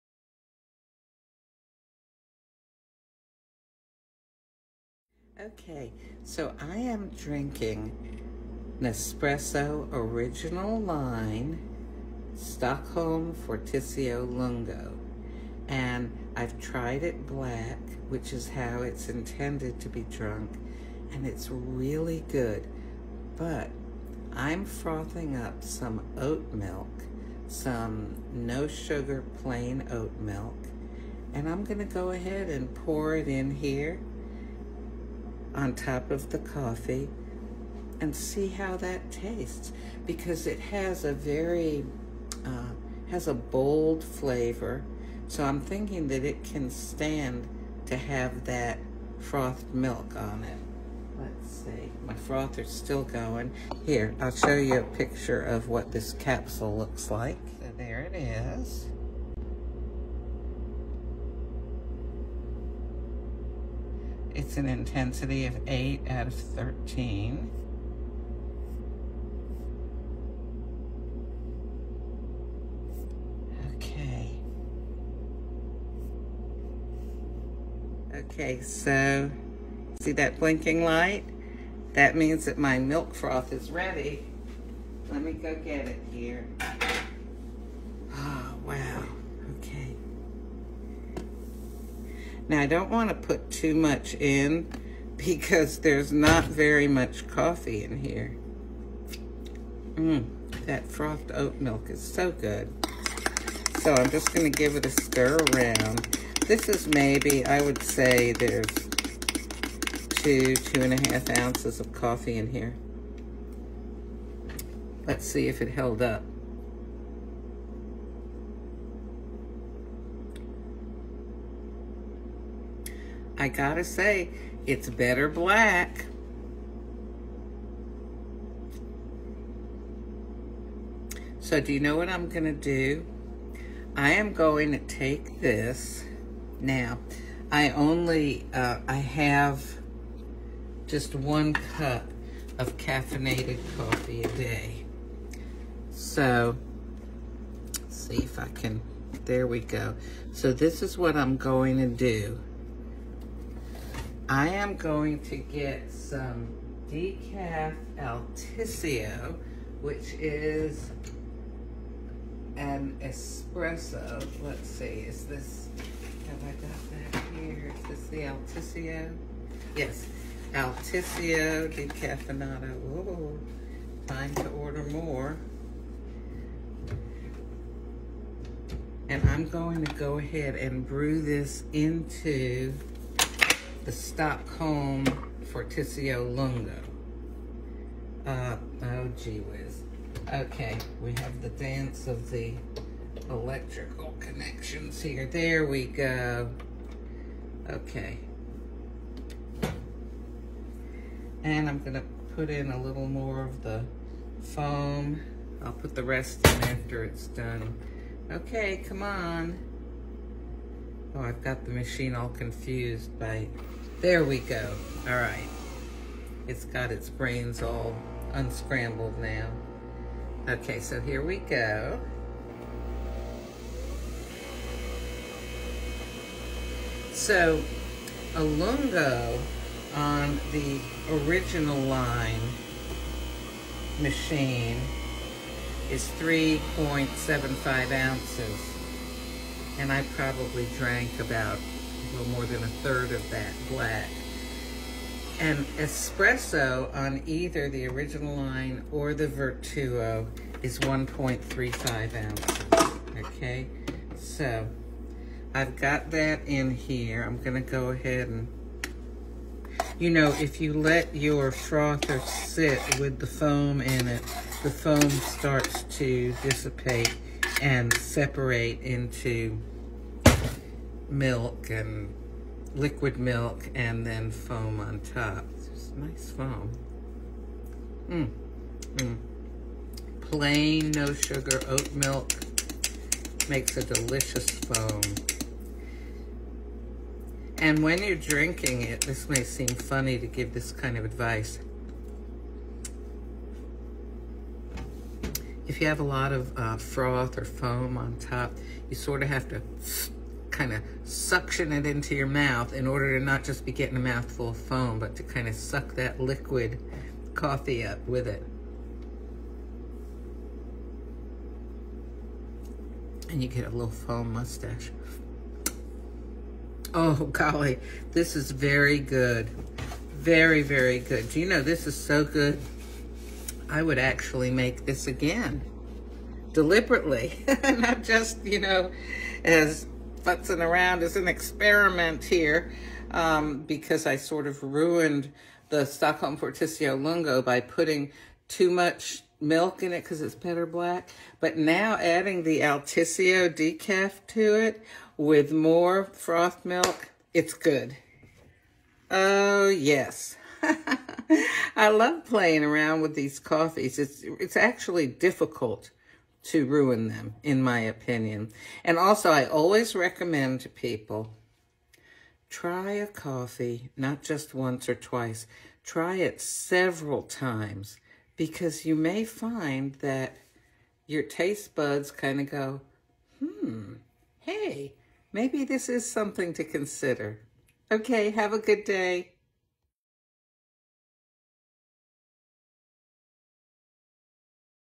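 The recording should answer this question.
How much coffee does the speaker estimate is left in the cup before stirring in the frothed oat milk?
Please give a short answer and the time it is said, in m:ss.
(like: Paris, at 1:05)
2 to 2.5 ounces, at 1:50.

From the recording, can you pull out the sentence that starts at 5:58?
And also, I always recommend to people, try a coffee, not just once or twice.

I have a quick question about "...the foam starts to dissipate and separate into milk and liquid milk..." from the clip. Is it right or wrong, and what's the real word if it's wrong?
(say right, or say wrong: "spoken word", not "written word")
right.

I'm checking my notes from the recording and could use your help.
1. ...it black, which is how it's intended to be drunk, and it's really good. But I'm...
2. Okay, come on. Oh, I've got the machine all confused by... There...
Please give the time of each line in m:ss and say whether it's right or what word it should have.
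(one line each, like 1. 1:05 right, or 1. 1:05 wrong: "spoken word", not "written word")
1. 0:17 right
2. 3:28 right.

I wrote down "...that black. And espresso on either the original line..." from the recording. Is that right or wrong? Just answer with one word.
right.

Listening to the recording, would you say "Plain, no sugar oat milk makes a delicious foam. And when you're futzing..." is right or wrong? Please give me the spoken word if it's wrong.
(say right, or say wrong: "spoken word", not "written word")
wrong: "drinking", not "futzing".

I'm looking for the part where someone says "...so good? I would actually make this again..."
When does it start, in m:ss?
5:21.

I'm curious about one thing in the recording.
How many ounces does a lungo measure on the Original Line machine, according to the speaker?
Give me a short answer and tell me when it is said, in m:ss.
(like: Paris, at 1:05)
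3.75 ounces, at 3:56.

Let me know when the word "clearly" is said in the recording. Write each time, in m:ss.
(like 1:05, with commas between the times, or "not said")
not said.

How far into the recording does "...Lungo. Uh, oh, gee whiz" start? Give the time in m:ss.
3:06.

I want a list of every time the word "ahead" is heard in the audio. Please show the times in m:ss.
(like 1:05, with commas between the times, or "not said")
0:32, 3:00, 4:17.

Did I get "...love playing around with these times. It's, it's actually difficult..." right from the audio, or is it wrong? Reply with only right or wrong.
wrong.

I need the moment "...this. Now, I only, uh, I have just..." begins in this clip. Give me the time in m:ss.
2:15.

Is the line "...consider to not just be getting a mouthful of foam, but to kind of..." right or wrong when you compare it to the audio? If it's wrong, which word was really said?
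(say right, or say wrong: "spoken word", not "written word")
wrong: "order", not "consider".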